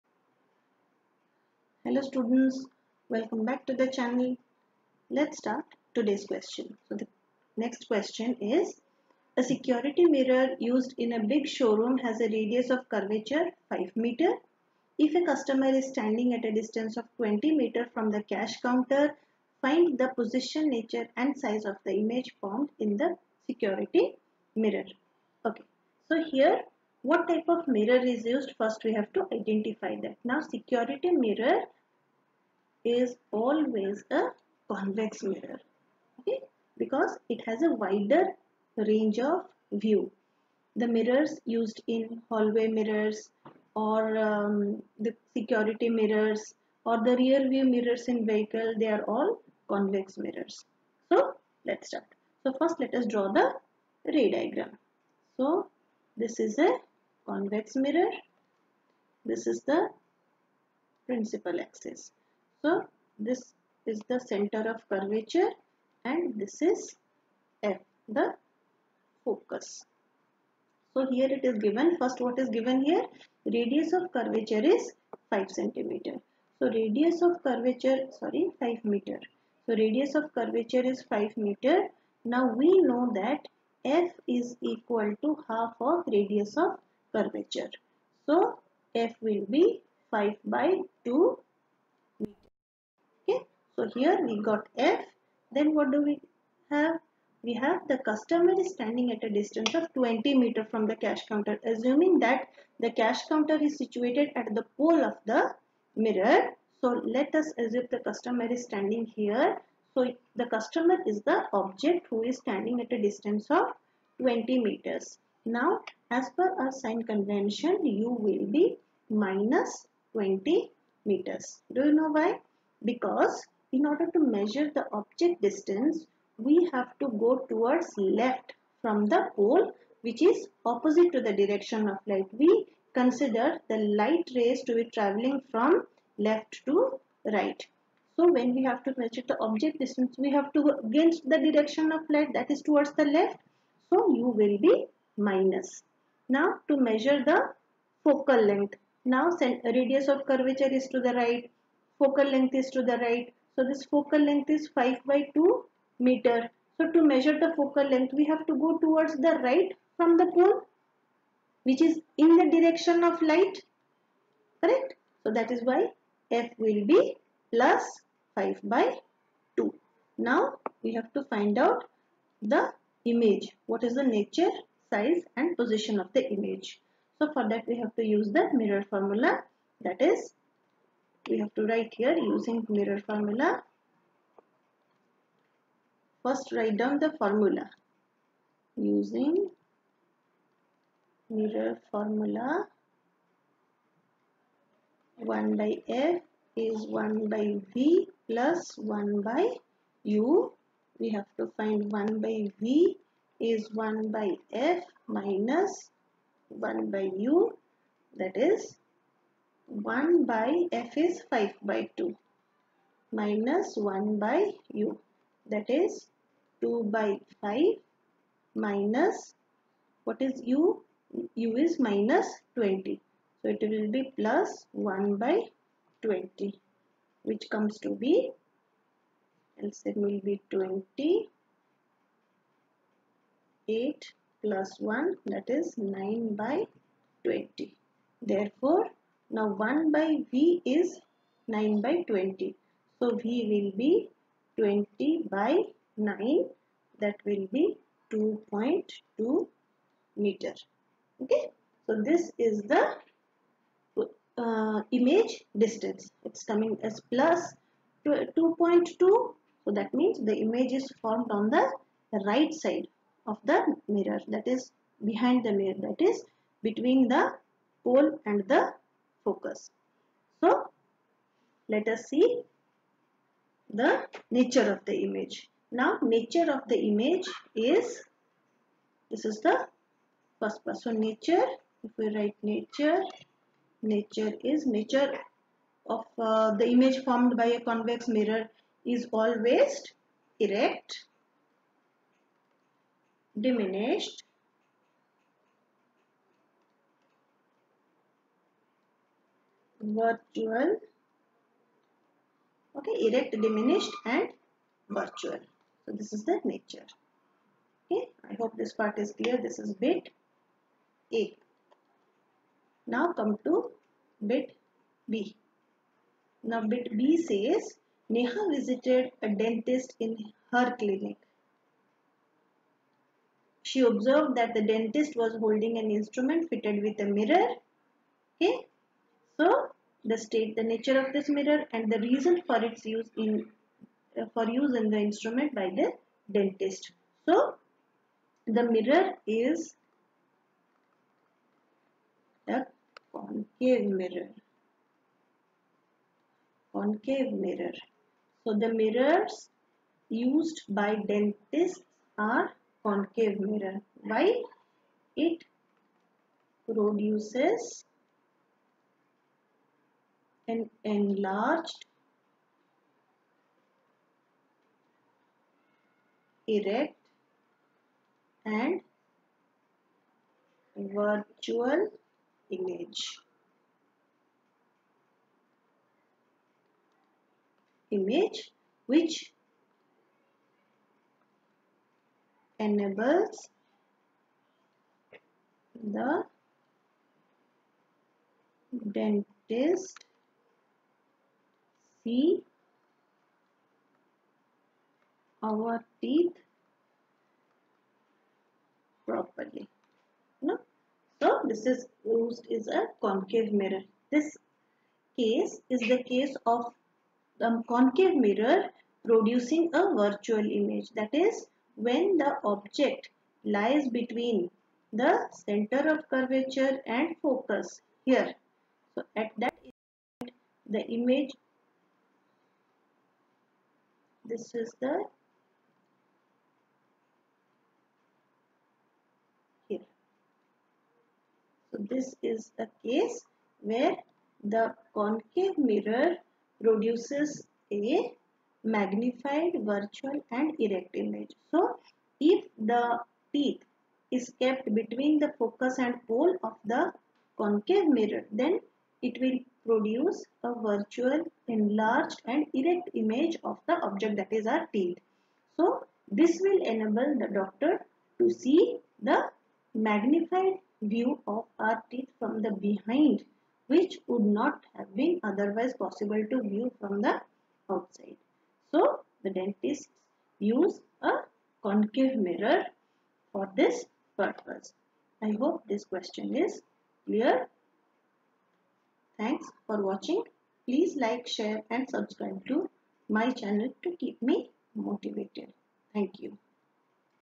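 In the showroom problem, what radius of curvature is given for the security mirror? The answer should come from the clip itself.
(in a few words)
5 meters.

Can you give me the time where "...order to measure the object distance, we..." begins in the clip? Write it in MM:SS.
02:03.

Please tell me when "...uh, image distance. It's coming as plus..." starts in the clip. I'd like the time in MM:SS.
04:14.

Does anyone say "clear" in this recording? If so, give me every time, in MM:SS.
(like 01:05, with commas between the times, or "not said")
05:09, 07:57.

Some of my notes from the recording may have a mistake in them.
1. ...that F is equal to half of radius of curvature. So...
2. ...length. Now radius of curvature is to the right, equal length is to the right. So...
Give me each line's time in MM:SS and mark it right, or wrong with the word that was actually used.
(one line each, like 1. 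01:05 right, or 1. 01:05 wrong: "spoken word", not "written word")
1. 01:23 right
2. 02:28 wrong: "focal", not "equal".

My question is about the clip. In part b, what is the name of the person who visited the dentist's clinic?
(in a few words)
Neha.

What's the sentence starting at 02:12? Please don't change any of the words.
We consider the light rays to be traveling from left to right.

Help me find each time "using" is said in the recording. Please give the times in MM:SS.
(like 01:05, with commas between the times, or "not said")
03:02, 03:08.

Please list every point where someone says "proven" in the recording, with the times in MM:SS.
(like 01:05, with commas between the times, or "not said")
not said.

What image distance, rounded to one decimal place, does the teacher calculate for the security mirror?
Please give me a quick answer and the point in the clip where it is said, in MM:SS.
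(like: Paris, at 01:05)
2.2 meters, at 04:08.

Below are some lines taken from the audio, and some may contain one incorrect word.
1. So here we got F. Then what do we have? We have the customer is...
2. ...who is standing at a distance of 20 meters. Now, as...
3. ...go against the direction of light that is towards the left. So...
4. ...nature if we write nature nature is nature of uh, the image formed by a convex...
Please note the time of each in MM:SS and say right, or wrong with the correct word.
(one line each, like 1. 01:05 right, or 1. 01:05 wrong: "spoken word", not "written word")
1. 01:33 right
2. 01:52 right
3. 02:20 right
4. 04:40 right.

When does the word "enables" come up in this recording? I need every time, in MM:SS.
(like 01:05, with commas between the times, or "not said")
06:22, 07:36.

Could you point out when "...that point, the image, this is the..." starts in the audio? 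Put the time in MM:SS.
06:59.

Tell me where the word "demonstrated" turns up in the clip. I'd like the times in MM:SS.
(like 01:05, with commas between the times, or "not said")
not said.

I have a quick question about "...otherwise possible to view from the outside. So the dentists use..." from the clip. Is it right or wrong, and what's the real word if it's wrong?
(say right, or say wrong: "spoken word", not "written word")
right.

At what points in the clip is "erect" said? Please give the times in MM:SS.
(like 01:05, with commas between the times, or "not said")
04:50, 05:03, 06:06, 07:20, 07:32.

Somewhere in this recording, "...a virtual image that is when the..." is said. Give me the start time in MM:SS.
06:49.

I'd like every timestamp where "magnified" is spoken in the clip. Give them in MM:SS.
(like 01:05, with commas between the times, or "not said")
07:18, 07:39.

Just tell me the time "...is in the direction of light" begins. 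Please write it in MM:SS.
02:41.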